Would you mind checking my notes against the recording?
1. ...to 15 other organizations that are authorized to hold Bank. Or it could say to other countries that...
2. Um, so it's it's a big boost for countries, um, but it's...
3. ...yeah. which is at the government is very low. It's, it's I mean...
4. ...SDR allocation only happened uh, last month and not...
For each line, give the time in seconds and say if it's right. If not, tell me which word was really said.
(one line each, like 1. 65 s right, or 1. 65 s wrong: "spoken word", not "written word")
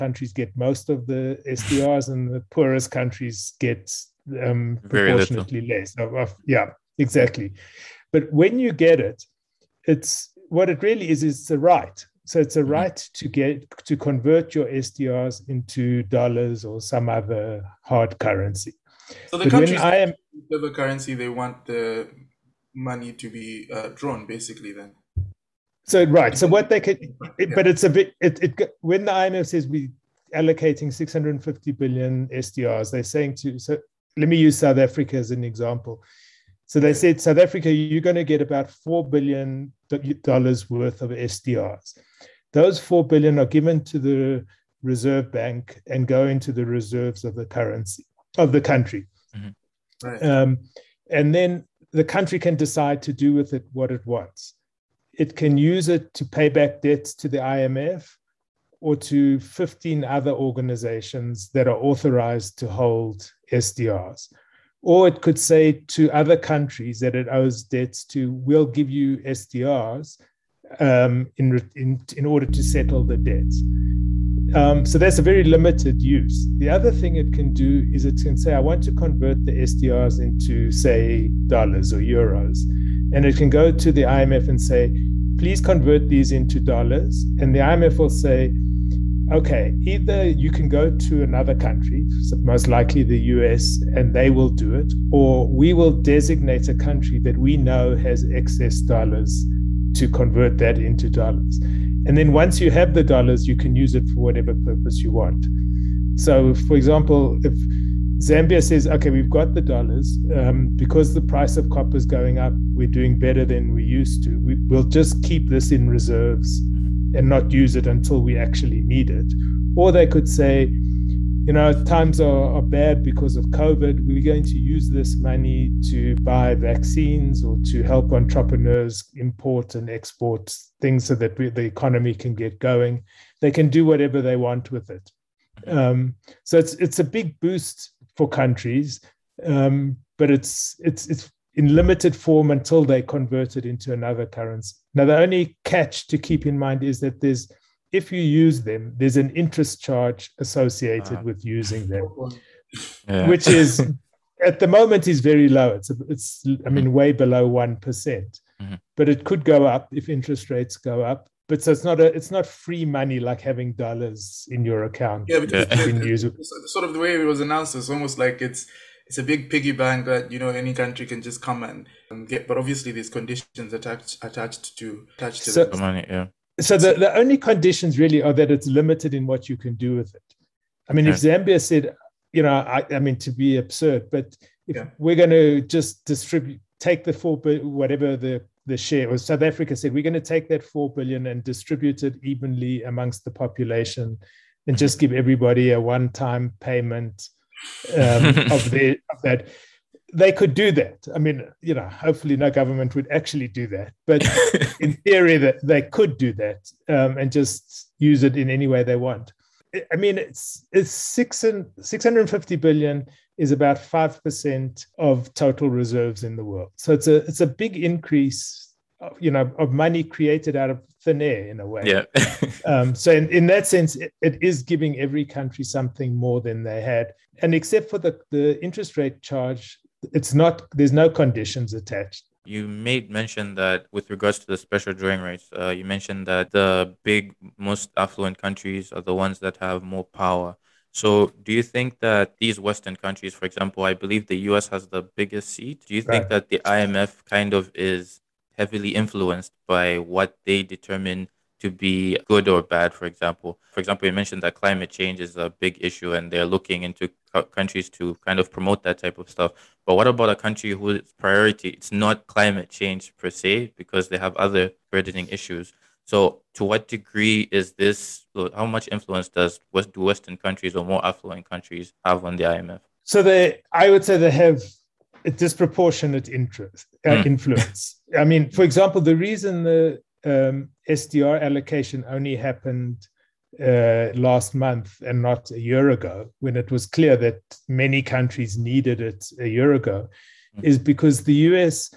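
1. 58 s wrong: "SDRs", not "Bank"
2. 135 s right
3. 153 s wrong: "moment", not "government"
4. 280 s right.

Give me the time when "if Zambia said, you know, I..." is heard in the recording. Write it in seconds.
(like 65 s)
181 s.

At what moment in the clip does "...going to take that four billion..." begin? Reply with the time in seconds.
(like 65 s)
190 s.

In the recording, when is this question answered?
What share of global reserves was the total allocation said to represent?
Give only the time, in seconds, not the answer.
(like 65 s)
213 s.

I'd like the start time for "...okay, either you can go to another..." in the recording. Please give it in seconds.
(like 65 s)
89 s.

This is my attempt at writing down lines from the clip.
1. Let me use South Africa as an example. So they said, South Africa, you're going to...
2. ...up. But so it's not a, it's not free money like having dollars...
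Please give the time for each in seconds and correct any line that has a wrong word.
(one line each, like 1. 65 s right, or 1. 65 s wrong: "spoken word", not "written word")
1. 34 s right
2. 161 s right.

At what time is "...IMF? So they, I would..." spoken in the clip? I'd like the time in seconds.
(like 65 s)
272 s.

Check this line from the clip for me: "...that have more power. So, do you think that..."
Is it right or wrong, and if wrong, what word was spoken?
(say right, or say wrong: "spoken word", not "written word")
right.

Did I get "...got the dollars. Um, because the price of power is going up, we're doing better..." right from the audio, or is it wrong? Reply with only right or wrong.
wrong.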